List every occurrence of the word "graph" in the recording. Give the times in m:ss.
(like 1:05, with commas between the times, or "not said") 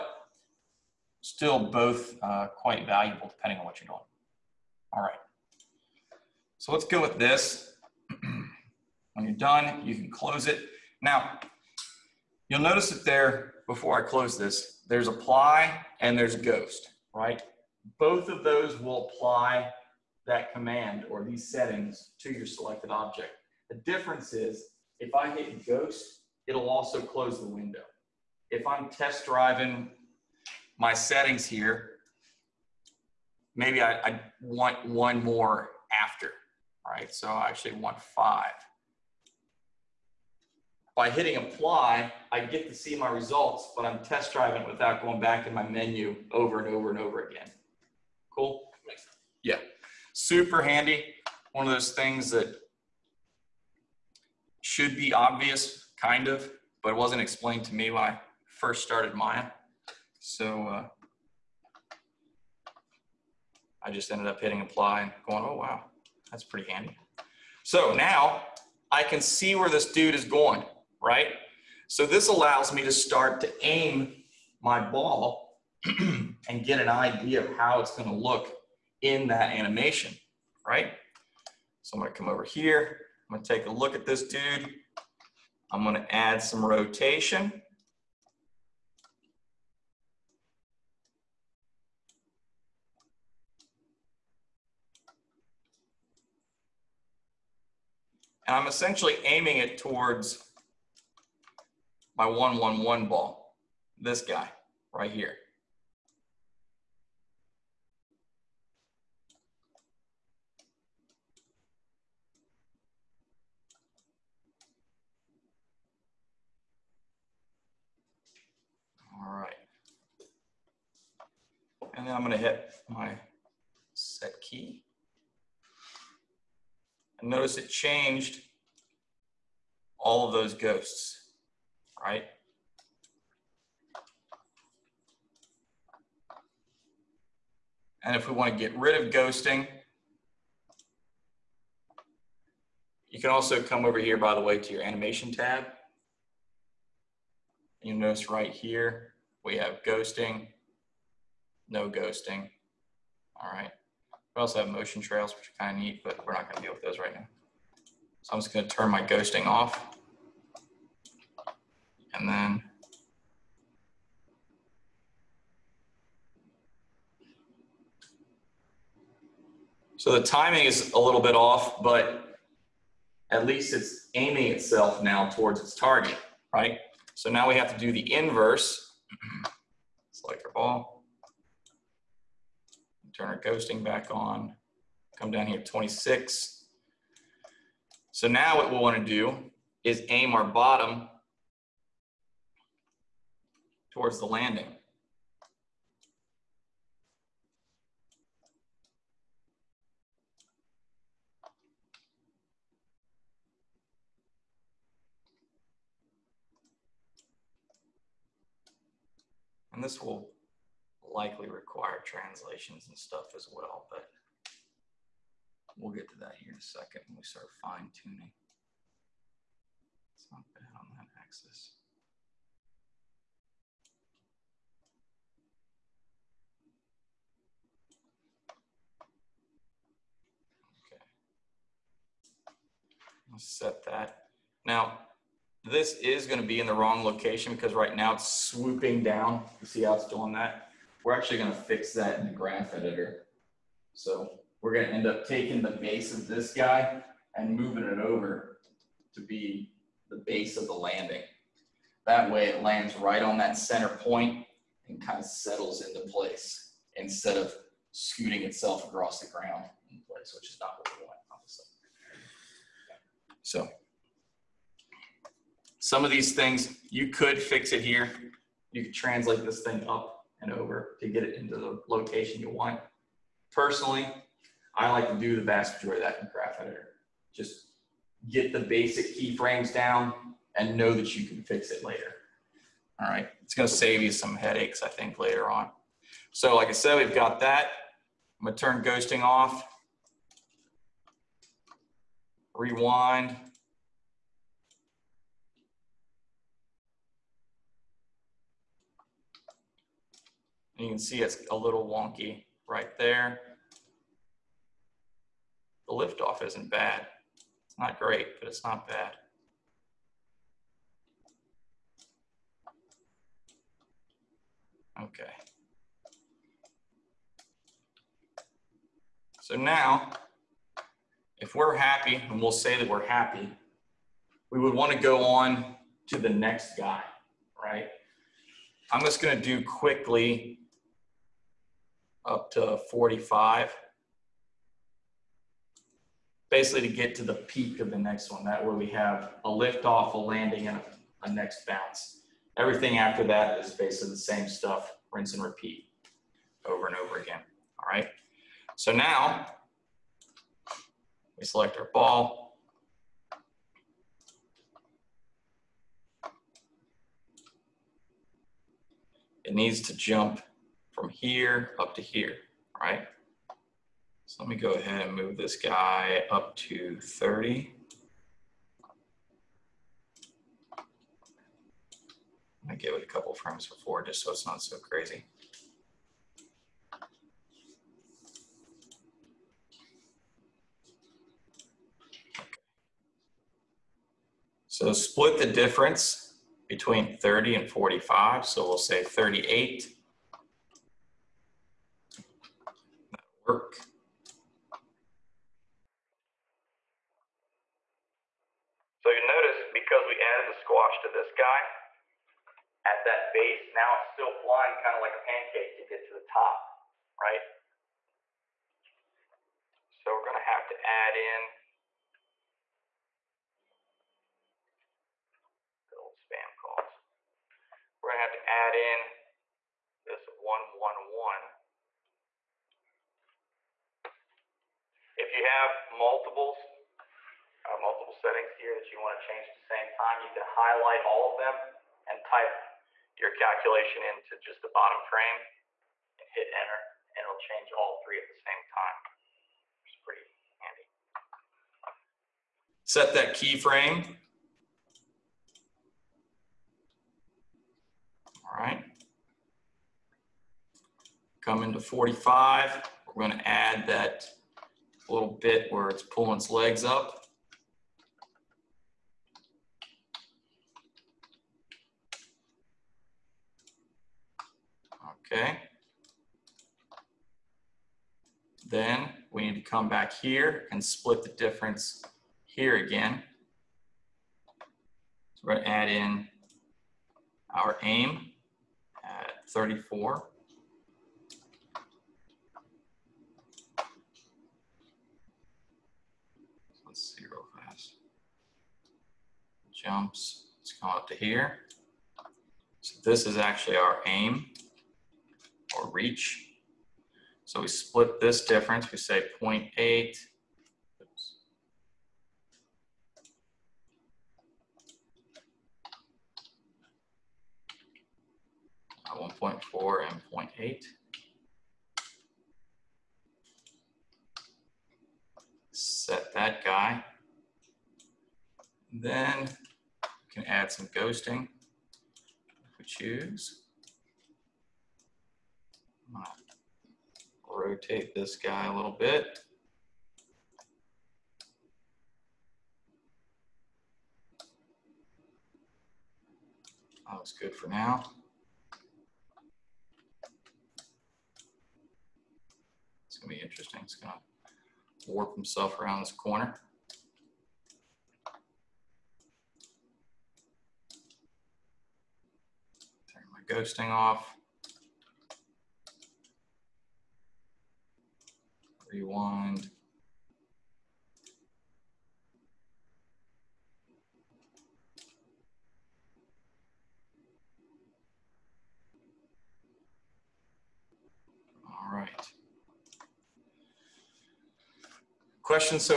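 4:02, 4:36.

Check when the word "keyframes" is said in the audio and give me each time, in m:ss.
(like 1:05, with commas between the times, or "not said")
4:39, 7:23.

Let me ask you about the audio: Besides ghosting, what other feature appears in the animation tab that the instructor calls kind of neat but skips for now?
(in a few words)
motion trails.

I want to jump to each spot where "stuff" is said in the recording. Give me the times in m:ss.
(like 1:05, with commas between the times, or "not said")
3:32, 5:44.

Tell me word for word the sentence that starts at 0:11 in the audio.
Now, you'll notice that there, before I close this, there's apply and there's ghost, right?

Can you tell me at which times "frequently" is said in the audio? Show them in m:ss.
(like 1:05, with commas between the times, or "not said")
not said.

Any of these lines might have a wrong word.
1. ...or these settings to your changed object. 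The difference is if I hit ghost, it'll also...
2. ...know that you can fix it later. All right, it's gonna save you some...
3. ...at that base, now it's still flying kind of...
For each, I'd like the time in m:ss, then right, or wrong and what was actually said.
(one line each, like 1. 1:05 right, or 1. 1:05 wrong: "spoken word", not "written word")
1. 0:21 wrong: "selected", not "changed"
2. 4:40 right
3. 6:42 right.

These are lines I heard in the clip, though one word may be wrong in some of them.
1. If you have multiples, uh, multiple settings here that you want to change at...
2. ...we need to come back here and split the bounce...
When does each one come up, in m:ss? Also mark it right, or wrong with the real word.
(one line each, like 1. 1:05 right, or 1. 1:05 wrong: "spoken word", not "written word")
1. 7:05 right
2. 7:49 wrong: "difference", not "bounce".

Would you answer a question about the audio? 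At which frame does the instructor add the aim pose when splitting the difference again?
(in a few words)
34.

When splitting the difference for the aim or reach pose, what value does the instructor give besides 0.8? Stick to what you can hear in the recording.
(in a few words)
1.4.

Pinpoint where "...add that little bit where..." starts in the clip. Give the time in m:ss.
7:33.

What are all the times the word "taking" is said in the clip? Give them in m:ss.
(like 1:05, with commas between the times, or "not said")
4:05.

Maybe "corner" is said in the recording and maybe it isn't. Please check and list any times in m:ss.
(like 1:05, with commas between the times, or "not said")
9:06.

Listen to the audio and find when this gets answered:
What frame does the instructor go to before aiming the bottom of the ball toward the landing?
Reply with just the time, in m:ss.
3:05.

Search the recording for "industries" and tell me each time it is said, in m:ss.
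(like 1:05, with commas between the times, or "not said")
not said.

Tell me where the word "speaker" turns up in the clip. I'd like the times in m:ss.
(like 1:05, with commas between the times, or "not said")
not said.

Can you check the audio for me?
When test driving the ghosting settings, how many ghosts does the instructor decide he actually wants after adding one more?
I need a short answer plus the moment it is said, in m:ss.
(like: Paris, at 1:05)
5, at 0:37.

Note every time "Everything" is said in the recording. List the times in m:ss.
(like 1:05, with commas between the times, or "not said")
5:42.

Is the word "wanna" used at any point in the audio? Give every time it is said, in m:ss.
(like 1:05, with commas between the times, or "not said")
3:08.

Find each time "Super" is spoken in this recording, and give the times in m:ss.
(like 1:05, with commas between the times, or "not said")
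0:50.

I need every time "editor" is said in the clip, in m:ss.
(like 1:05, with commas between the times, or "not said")
4:02, 4:36.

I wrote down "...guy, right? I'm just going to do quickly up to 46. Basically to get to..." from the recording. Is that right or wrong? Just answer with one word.
wrong.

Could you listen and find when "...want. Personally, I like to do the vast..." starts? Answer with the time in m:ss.
4:32.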